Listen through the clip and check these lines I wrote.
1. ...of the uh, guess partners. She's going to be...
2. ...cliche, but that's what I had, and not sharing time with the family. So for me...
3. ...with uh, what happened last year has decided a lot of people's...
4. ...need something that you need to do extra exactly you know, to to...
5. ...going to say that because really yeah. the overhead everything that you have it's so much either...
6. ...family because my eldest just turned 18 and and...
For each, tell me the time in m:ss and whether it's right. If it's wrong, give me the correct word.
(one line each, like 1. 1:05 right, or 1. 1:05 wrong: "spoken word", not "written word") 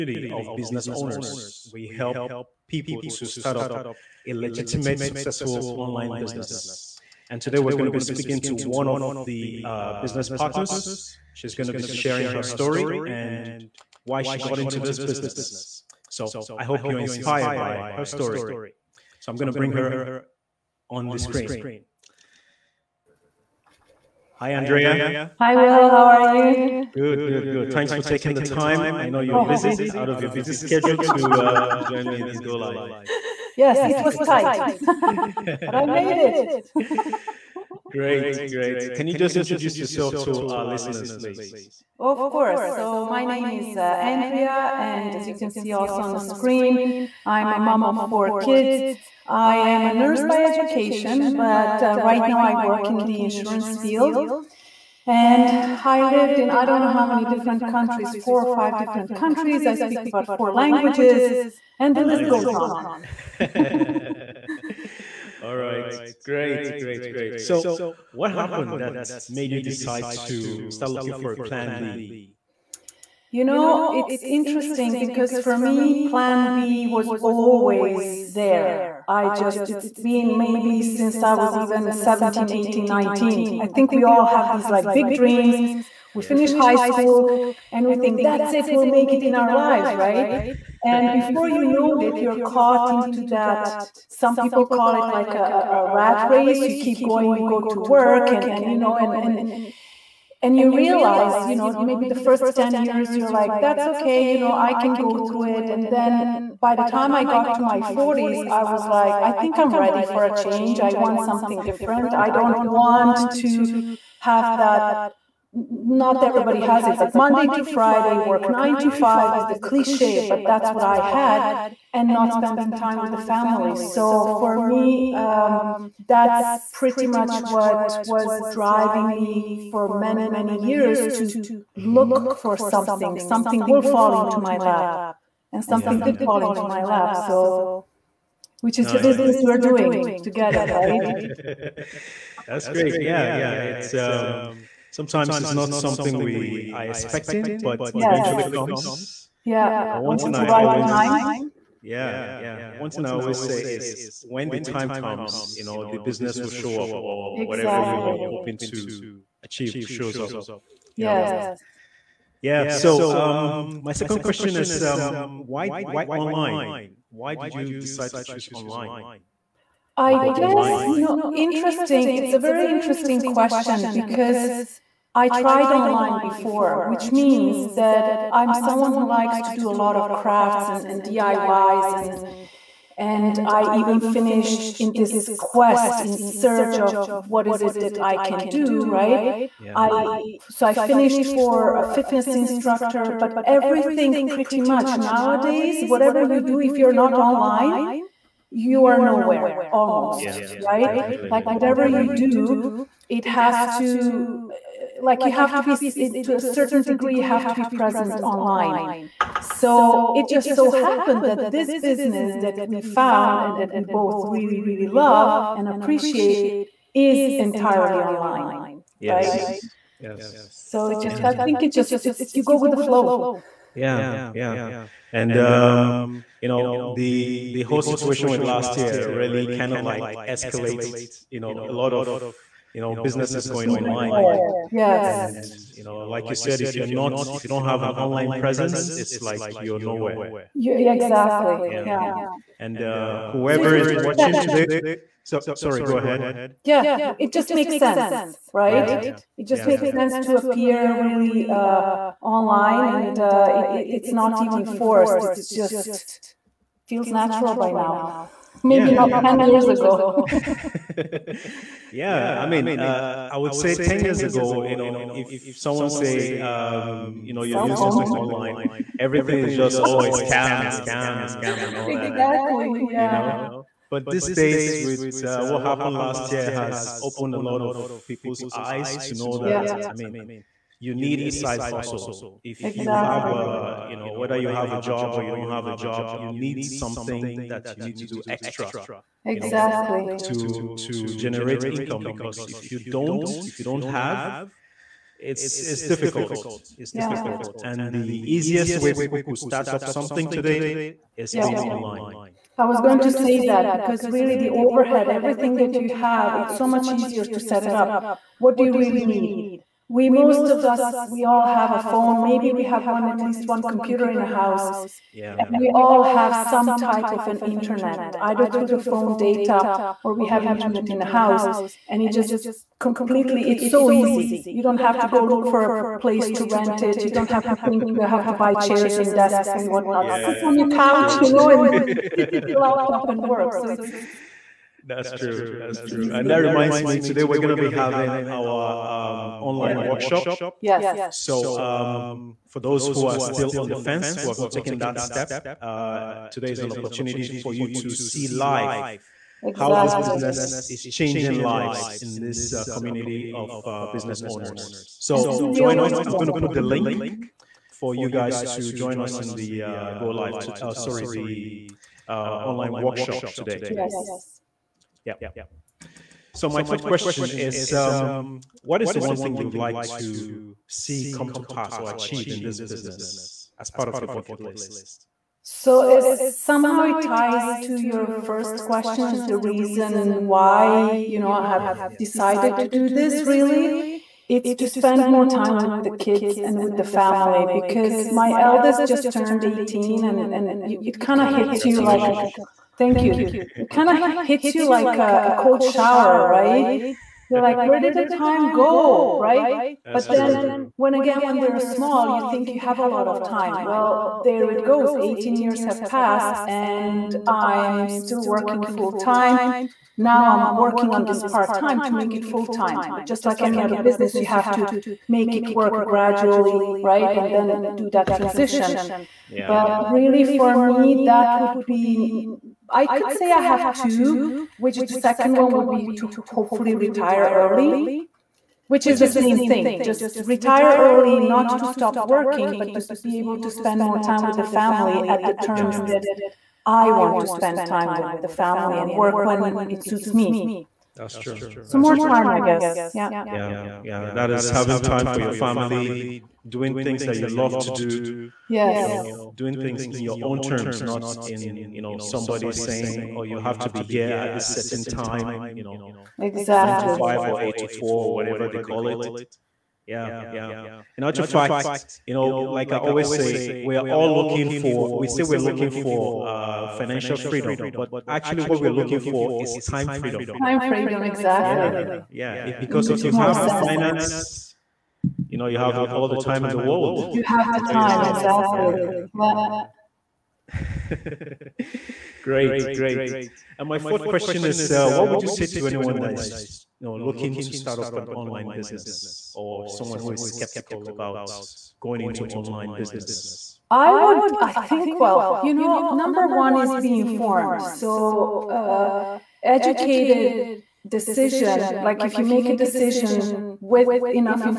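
1. 0:08 wrong: "business", not "guess"
2. 1:59 wrong: "spending", not "sharing"
3. 4:34 wrong: "opened", not "decided"
4. 4:46 right
5. 5:02 wrong: "easier", not "either"
6. 6:26 right.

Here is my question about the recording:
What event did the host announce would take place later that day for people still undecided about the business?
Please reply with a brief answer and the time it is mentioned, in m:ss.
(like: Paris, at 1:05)
Online workshop, at 6:02.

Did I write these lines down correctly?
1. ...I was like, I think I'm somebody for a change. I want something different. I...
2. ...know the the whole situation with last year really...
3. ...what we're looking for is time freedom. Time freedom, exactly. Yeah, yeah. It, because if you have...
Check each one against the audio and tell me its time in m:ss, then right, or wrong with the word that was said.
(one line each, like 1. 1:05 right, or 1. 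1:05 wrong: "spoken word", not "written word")
1. 1:48 wrong: "ready", not "somebody"
2. 3:46 right
3. 7:48 right.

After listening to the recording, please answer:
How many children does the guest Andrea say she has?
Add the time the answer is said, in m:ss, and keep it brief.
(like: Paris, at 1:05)
4, at 0:47.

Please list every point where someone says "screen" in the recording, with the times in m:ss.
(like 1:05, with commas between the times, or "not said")
0:21, 0:46.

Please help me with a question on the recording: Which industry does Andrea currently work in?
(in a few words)
Insurance.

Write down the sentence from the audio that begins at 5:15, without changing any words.
And we all have some type of an internet, either through the phone data or we have internet in the house.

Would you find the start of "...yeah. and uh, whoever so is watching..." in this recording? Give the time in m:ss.
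4:01.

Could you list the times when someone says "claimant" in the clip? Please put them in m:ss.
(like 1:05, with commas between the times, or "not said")
not said.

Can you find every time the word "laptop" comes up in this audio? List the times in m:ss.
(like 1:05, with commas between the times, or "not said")
5:32.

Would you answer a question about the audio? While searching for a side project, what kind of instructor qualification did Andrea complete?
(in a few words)
Fitness instructor.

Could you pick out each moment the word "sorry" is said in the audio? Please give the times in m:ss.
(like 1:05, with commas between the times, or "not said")
4:05, 6:00.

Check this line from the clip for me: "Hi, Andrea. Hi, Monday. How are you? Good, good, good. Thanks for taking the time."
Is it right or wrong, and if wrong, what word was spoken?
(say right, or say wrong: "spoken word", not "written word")
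wrong: "Will", not "Monday".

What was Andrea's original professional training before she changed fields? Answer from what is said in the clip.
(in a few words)
Nurse.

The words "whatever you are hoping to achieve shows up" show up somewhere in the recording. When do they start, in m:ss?
2:37.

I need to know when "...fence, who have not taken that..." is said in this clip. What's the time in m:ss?
5:43.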